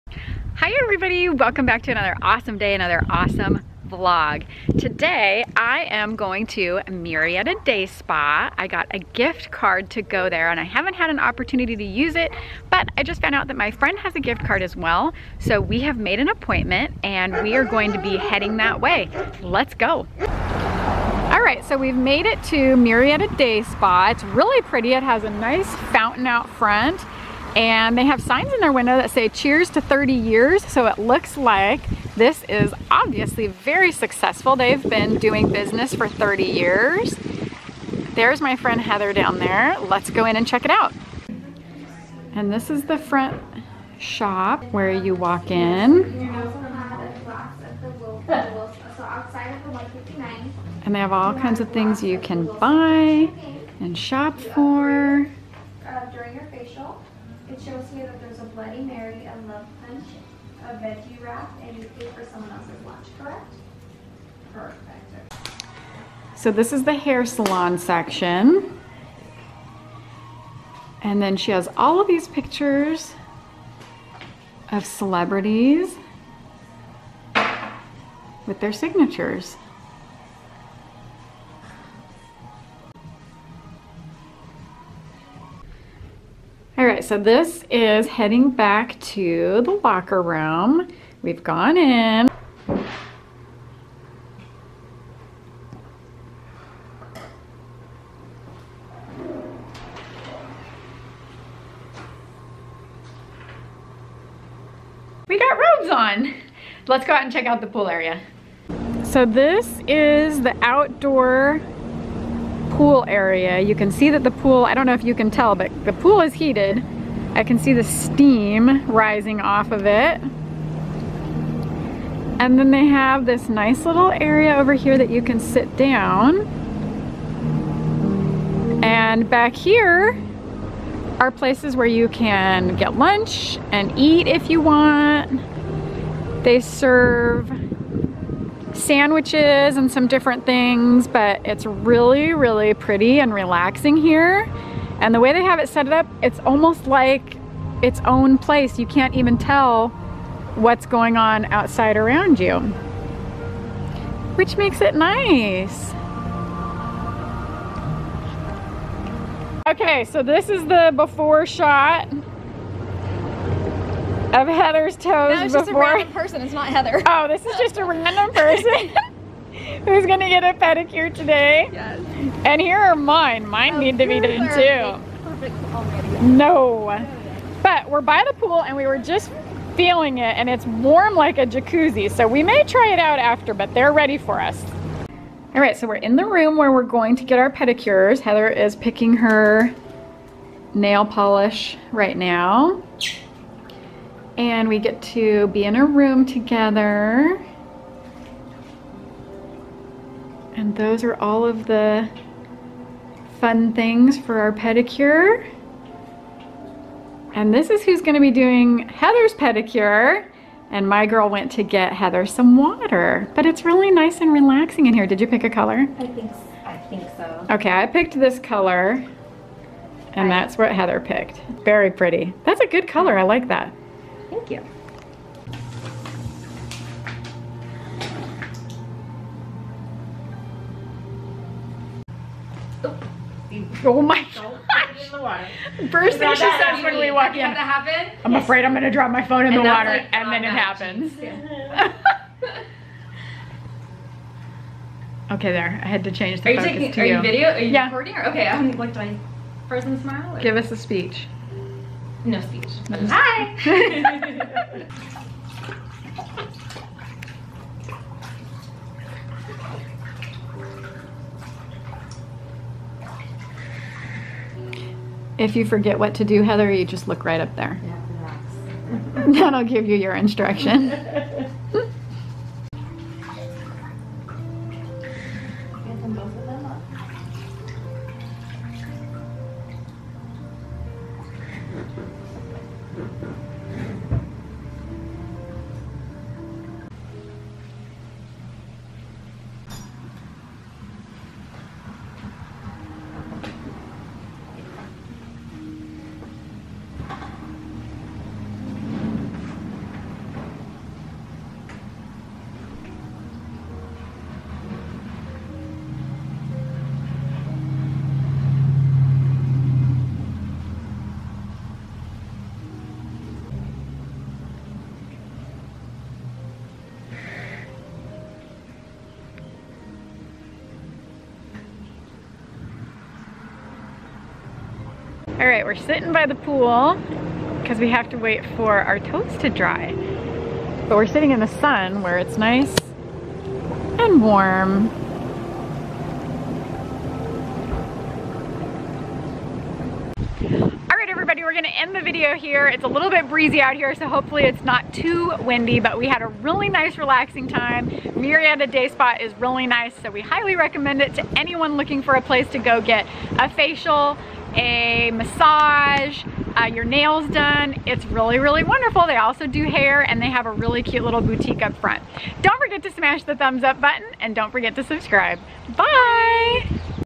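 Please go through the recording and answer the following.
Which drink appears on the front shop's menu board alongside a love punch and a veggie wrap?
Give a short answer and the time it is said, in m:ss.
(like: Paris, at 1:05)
Bloody Mary, at 0:58.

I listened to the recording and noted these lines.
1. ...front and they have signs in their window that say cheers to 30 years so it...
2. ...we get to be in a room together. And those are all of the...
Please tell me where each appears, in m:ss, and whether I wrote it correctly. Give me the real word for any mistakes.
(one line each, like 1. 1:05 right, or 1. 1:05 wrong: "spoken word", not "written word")
1. 0:26 right
2. 3:14 right.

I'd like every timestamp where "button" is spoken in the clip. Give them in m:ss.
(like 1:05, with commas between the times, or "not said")
6:03.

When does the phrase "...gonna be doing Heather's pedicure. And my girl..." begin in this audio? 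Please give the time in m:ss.
3:28.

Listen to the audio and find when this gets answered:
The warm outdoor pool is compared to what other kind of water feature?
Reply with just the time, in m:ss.
3:01.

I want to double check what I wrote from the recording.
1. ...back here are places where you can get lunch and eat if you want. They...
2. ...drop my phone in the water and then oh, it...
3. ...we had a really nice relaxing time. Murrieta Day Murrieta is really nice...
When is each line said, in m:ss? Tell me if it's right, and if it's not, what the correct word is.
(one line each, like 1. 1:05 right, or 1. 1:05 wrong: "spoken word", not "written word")
1. 2:09 right
2. 3:58 right
3. 5:45 wrong: "Spa", not "Murrieta".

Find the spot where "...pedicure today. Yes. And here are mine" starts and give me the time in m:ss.
2:50.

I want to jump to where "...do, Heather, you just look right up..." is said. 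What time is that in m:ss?
4:26.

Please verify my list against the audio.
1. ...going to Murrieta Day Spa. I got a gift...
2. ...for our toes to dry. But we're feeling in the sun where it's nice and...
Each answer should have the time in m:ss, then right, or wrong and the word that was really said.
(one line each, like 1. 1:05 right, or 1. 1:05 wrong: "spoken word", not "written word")
1. 0:06 right
2. 5:28 wrong: "sitting", not "feeling".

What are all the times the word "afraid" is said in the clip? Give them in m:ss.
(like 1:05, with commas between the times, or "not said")
3:58.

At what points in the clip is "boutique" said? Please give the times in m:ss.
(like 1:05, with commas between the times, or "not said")
6:01.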